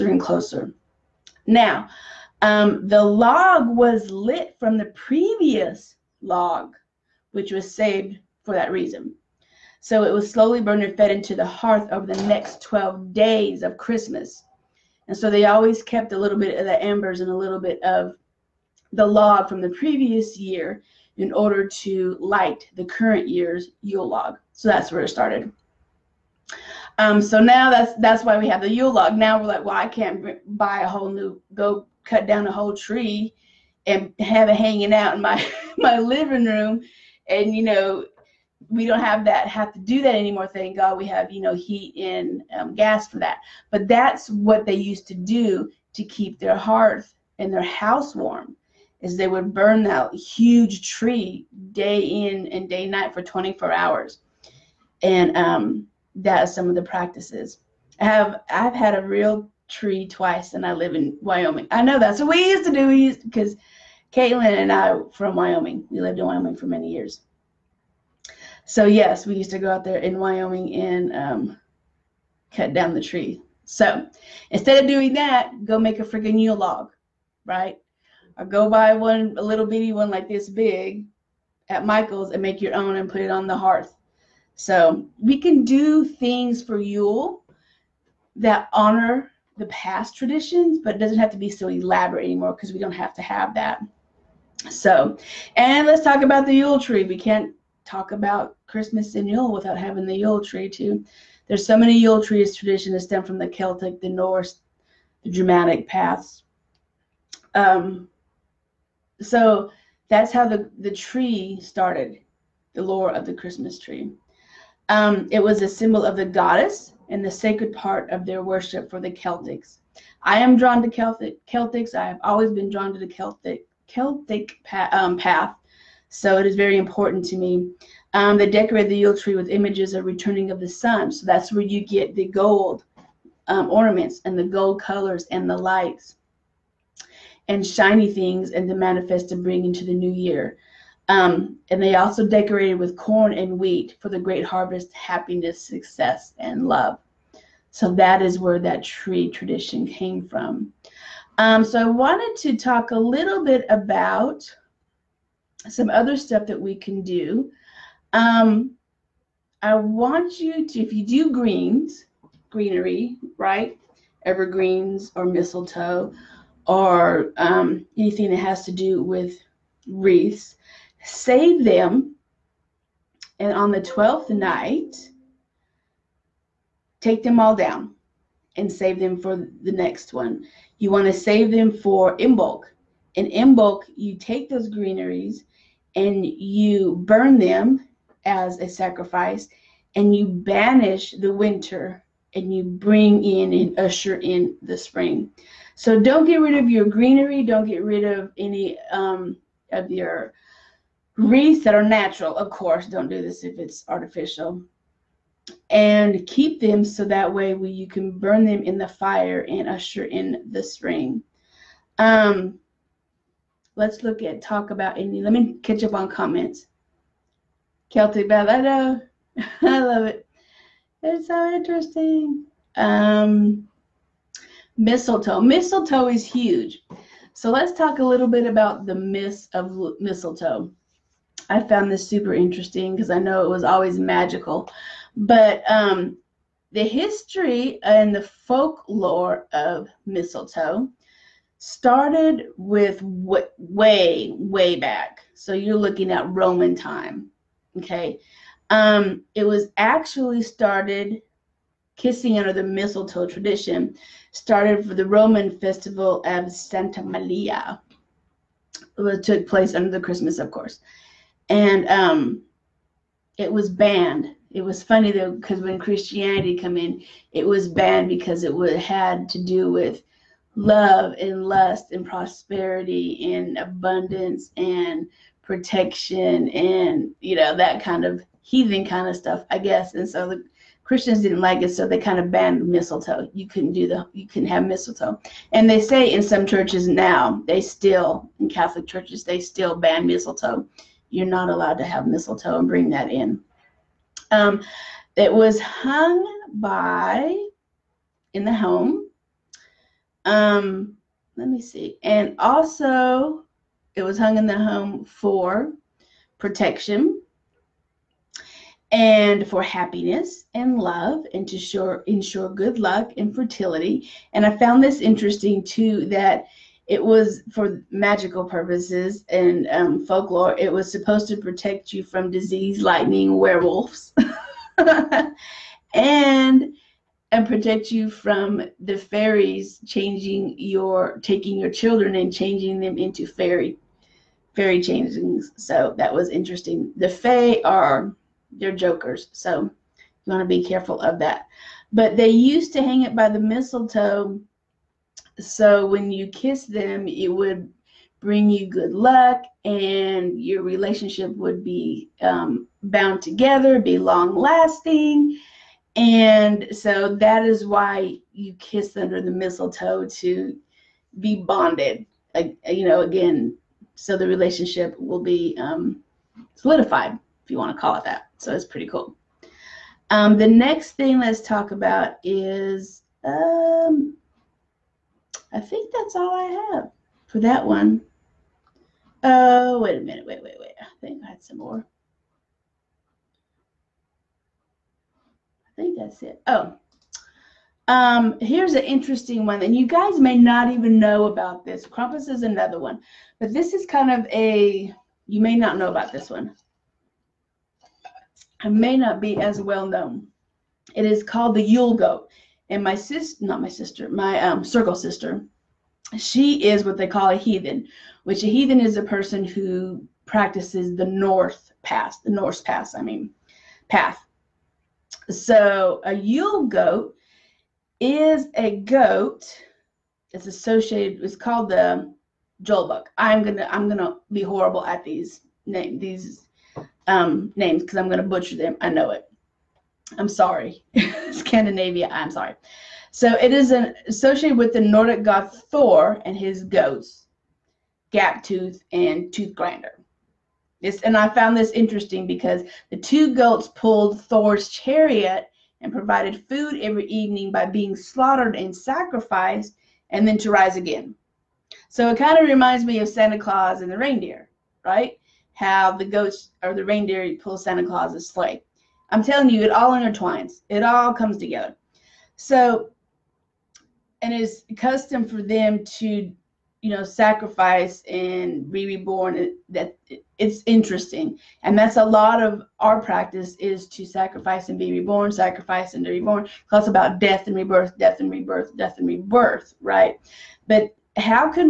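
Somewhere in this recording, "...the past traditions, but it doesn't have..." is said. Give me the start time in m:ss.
1:29.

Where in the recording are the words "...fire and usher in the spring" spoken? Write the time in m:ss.
3:28.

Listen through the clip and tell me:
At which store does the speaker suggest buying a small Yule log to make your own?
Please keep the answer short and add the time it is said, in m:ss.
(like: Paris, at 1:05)
Michael's, at 1:21.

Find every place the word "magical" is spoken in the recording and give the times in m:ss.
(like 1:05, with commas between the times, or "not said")
3:53, 5:17.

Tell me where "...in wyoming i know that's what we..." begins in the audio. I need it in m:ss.
1:00.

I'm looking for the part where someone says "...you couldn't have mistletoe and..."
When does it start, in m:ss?
4:44.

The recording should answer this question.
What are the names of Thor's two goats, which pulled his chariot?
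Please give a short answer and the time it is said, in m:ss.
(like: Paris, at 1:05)
Gaptooth and Tooth Grinder, at 7:18.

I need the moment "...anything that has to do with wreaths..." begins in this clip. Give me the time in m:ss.
2:47.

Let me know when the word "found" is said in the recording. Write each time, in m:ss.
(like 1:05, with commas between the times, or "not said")
3:51, 5:14, 7:21.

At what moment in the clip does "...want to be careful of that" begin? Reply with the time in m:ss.
5:40.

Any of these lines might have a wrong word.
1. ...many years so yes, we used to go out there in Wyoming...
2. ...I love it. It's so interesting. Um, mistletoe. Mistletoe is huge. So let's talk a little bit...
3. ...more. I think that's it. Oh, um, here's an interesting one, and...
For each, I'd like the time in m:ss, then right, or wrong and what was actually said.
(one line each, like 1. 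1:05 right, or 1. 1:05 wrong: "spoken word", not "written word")
1. 1:06 right
2. 3:39 right
3. 6:21 right.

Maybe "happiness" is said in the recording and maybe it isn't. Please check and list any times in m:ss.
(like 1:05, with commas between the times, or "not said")
2:24, 5:09.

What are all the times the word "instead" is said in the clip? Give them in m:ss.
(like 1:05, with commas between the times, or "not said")
1:14.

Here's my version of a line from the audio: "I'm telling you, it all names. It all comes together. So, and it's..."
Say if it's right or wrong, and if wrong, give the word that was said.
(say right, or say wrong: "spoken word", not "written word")
wrong: "intertwines", not "names".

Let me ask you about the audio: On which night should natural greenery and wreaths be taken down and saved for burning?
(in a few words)
12th night.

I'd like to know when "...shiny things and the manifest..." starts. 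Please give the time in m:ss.
2:17.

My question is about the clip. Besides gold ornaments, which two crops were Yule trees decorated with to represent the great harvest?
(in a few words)
corn and wheat.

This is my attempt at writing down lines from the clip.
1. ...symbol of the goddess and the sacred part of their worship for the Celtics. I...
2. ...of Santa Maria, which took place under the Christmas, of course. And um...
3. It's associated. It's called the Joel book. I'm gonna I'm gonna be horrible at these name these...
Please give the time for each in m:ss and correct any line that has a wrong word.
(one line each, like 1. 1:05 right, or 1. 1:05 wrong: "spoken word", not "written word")
1. 1:55 right
2. 4:16 right
3. 7:00 right.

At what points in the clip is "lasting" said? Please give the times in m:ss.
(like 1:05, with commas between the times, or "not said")
5:54.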